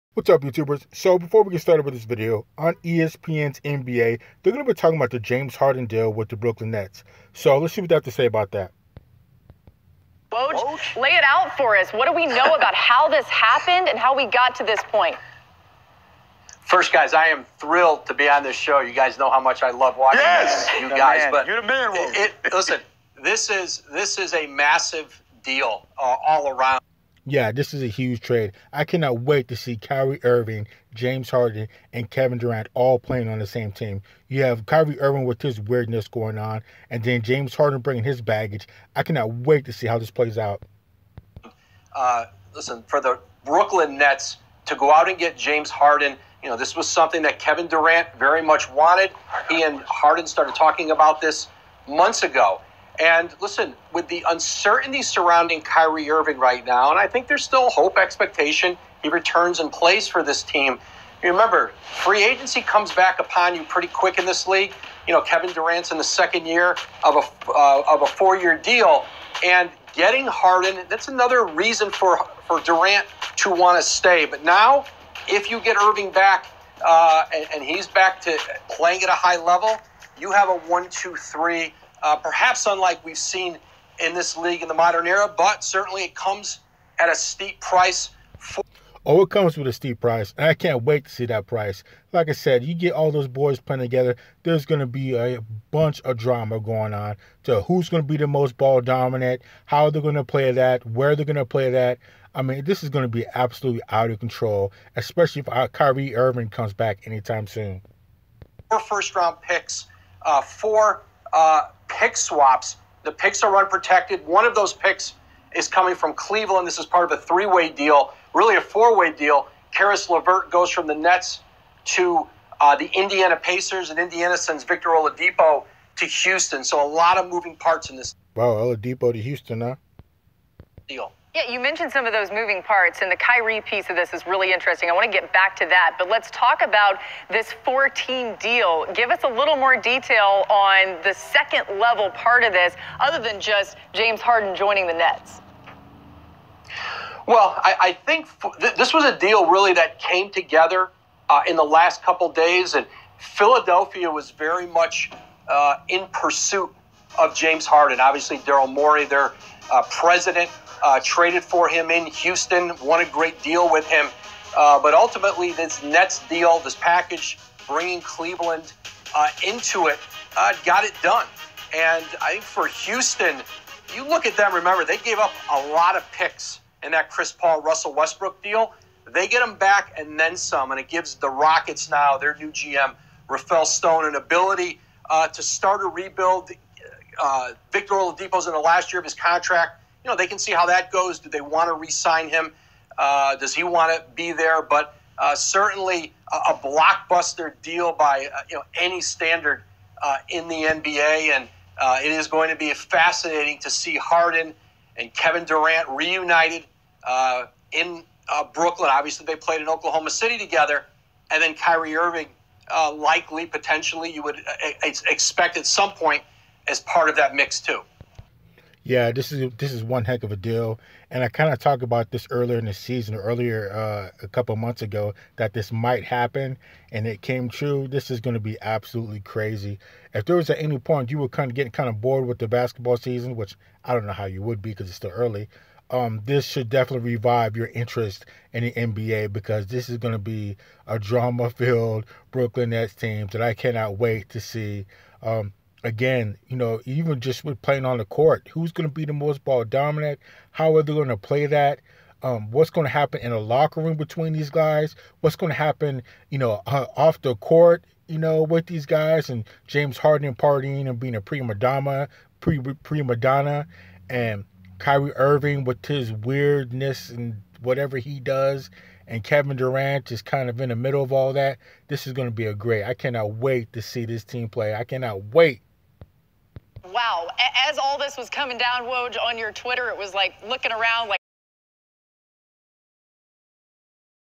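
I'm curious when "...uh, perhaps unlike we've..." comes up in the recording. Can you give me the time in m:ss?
1:22.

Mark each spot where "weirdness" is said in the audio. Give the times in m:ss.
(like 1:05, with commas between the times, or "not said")
0:35, 4:26.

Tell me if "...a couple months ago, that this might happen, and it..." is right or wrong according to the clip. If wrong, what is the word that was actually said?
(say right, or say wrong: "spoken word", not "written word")
right.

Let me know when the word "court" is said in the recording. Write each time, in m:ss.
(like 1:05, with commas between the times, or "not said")
4:08, 4:17.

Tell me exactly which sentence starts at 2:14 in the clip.
I want to get back to that, but let's talk about this four team deal.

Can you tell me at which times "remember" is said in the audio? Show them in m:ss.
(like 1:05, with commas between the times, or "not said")
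1:01, 2:54.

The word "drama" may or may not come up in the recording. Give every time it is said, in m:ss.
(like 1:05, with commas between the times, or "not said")
1:36, 4:00.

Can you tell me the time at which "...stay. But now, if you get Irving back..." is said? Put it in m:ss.
1:13.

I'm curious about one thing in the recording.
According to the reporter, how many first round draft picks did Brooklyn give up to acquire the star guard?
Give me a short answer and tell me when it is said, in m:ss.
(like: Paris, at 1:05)
4, at 1:48.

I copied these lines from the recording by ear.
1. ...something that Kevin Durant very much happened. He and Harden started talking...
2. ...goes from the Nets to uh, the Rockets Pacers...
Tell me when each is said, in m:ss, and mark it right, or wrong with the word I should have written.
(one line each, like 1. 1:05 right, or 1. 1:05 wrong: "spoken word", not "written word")
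1. 0:46 wrong: "wanted", not "happened"
2. 2:00 wrong: "Indiana", not "Rockets".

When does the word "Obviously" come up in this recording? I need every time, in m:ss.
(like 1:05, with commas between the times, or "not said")
2:38, 3:28.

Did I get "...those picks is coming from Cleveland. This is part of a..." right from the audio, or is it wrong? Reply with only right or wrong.
right.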